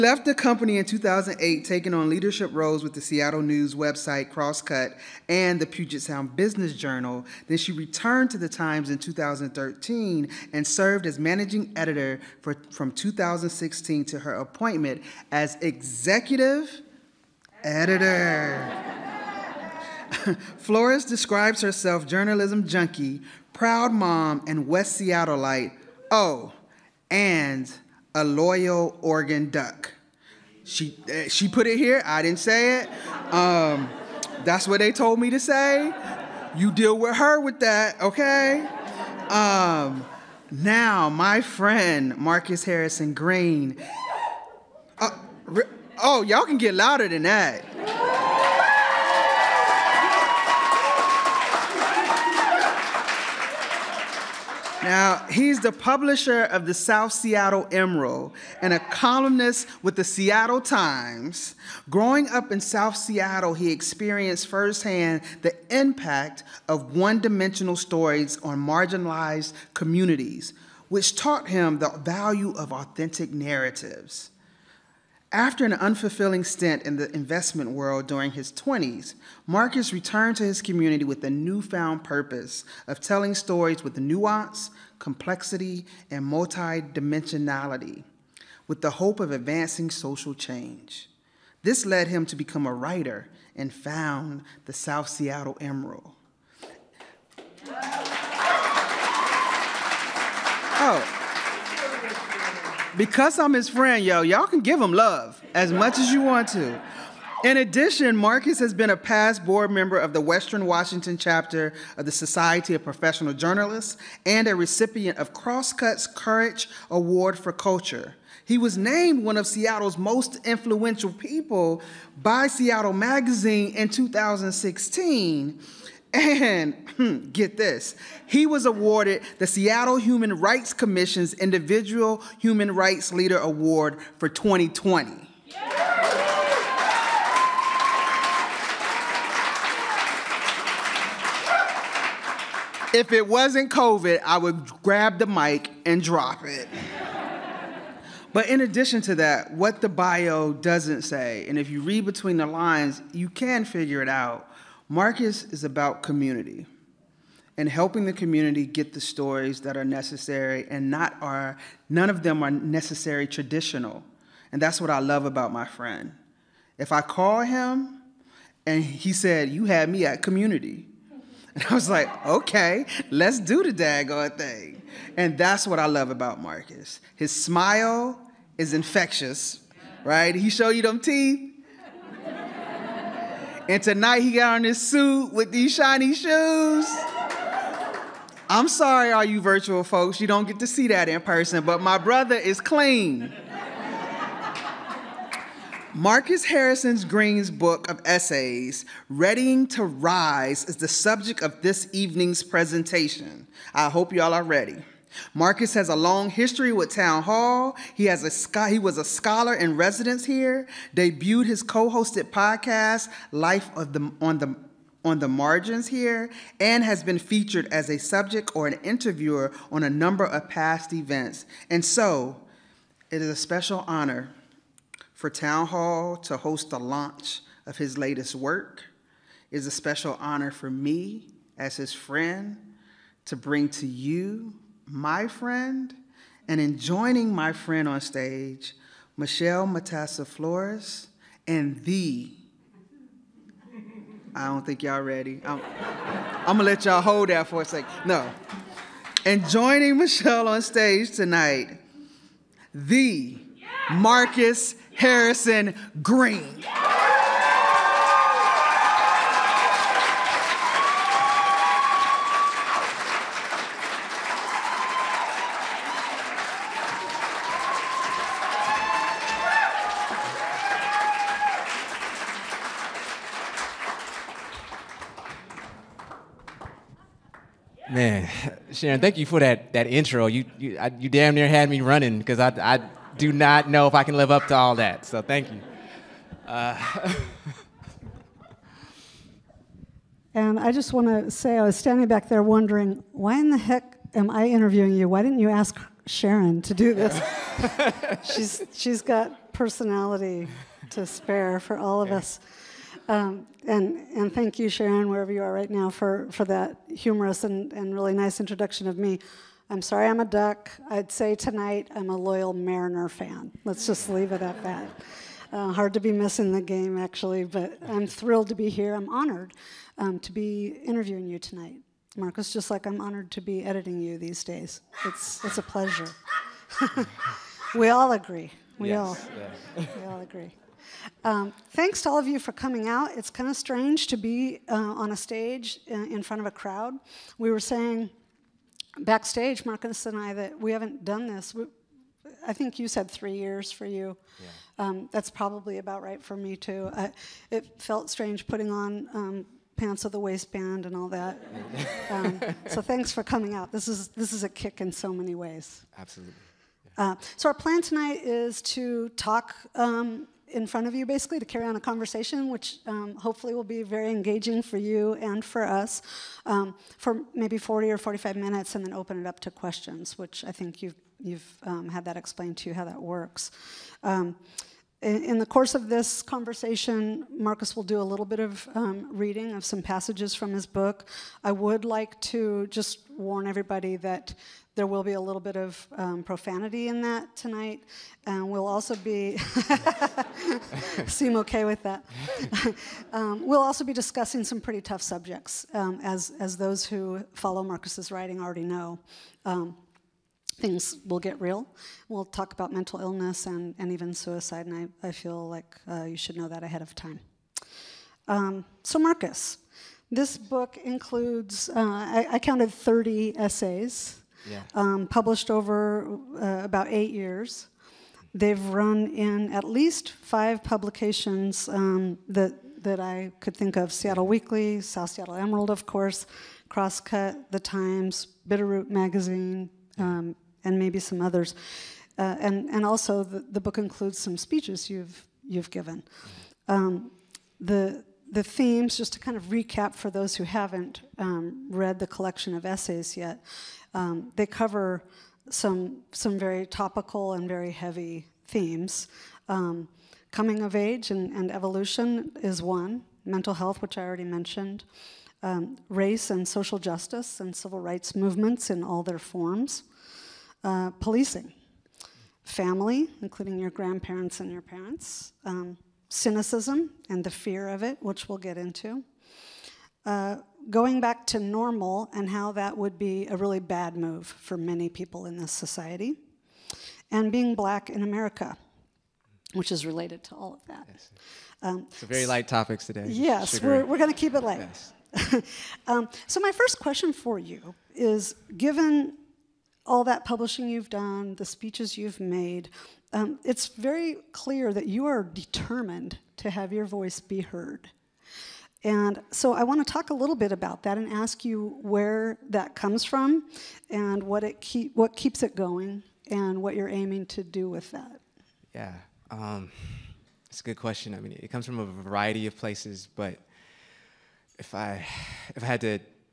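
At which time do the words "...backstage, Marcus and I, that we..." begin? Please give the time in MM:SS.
05:38.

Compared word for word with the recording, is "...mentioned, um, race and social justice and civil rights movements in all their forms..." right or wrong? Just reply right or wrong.
right.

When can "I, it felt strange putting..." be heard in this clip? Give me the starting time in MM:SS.
05:46.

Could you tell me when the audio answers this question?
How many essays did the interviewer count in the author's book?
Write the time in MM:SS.
06:52.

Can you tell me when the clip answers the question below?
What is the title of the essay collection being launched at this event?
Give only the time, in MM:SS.
03:19.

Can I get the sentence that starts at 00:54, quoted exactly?
Now, he's the publisher of the South Seattle Emerald and a columnist with the Seattle Times.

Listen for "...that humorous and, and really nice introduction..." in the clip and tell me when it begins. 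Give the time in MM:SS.
05:06.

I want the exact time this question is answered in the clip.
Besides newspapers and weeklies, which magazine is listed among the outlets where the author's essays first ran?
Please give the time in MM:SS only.
07:08.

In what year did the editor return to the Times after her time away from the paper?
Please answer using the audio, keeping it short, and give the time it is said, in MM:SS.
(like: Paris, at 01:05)
2013, at 00:08.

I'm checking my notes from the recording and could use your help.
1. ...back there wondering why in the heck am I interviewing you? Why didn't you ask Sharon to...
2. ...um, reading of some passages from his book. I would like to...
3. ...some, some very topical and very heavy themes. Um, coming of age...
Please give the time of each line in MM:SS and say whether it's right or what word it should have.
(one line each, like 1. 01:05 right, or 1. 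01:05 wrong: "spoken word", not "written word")
1. 04:52 right
2. 06:18 right
3. 07:25 right.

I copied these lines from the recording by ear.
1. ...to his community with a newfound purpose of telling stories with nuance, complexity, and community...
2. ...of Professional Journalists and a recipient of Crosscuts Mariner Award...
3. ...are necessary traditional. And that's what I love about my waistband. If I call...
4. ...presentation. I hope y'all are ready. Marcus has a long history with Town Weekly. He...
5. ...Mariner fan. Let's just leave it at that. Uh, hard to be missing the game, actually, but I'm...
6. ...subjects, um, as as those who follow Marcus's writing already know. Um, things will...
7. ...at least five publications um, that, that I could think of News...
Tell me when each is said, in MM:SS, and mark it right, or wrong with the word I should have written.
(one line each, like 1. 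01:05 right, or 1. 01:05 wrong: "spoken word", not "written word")
1. 01:20 wrong: "multidimensionality", not "community"
2. 01:52 wrong: "Courage", not "Mariner"
3. 02:42 wrong: "friend", not "waistband"
4. 03:22 wrong: "Hall", not "Weekly"
5. 05:12 right
6. 06:35 right
7. 06:59 wrong: "Seattle", not "News".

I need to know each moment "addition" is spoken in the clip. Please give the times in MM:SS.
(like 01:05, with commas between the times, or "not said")
01:47, 02:28.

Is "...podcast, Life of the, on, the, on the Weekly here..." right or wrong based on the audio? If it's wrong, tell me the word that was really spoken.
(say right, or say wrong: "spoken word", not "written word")
wrong: "Margins", not "Weekly".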